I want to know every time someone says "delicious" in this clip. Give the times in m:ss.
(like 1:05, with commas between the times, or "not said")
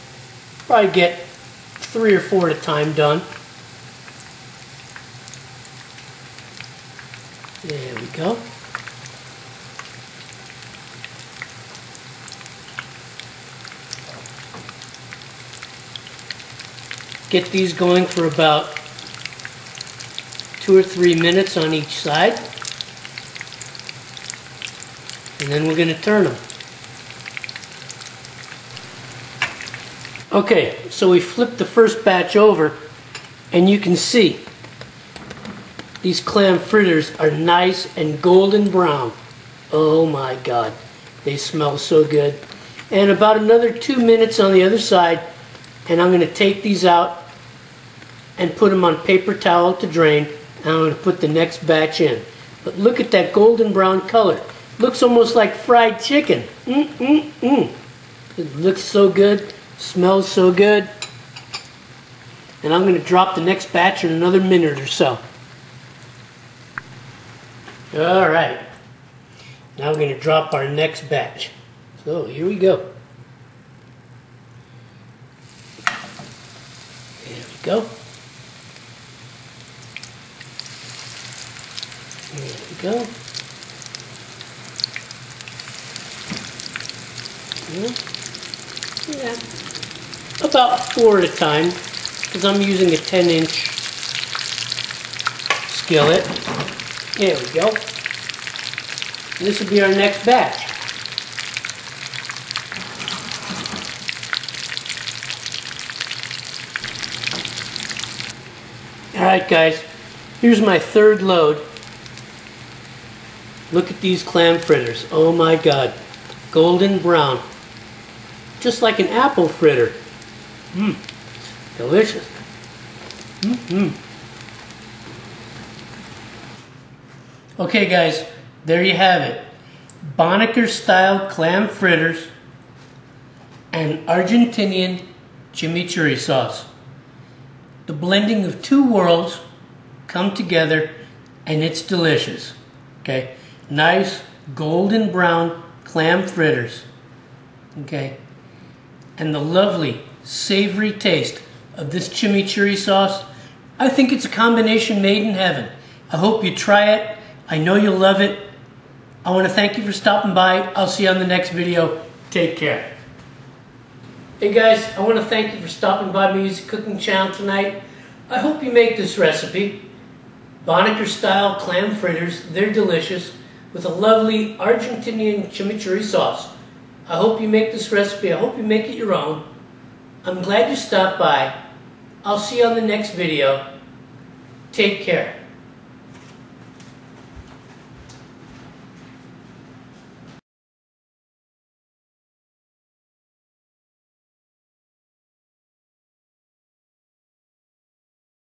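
2:01, 2:21, 2:52.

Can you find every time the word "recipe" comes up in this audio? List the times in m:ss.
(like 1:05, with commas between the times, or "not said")
2:49, 2:57.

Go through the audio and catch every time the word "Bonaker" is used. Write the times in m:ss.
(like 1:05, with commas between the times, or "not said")
2:10, 2:50.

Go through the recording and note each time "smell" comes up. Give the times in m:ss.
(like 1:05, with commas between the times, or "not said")
0:41, 0:59.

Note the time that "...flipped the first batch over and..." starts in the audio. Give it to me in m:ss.
0:31.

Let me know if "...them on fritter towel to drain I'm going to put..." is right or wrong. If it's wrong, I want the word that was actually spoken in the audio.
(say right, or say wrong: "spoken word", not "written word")
wrong: "paper", not "fritter".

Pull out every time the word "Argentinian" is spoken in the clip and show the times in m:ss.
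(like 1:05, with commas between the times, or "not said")
2:14, 2:54.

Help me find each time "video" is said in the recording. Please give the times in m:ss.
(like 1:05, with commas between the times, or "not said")
2:41, 3:03.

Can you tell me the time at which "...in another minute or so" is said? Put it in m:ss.
1:04.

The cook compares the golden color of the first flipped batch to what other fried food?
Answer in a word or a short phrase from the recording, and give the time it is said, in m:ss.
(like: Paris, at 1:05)
fried chicken, at 0:55.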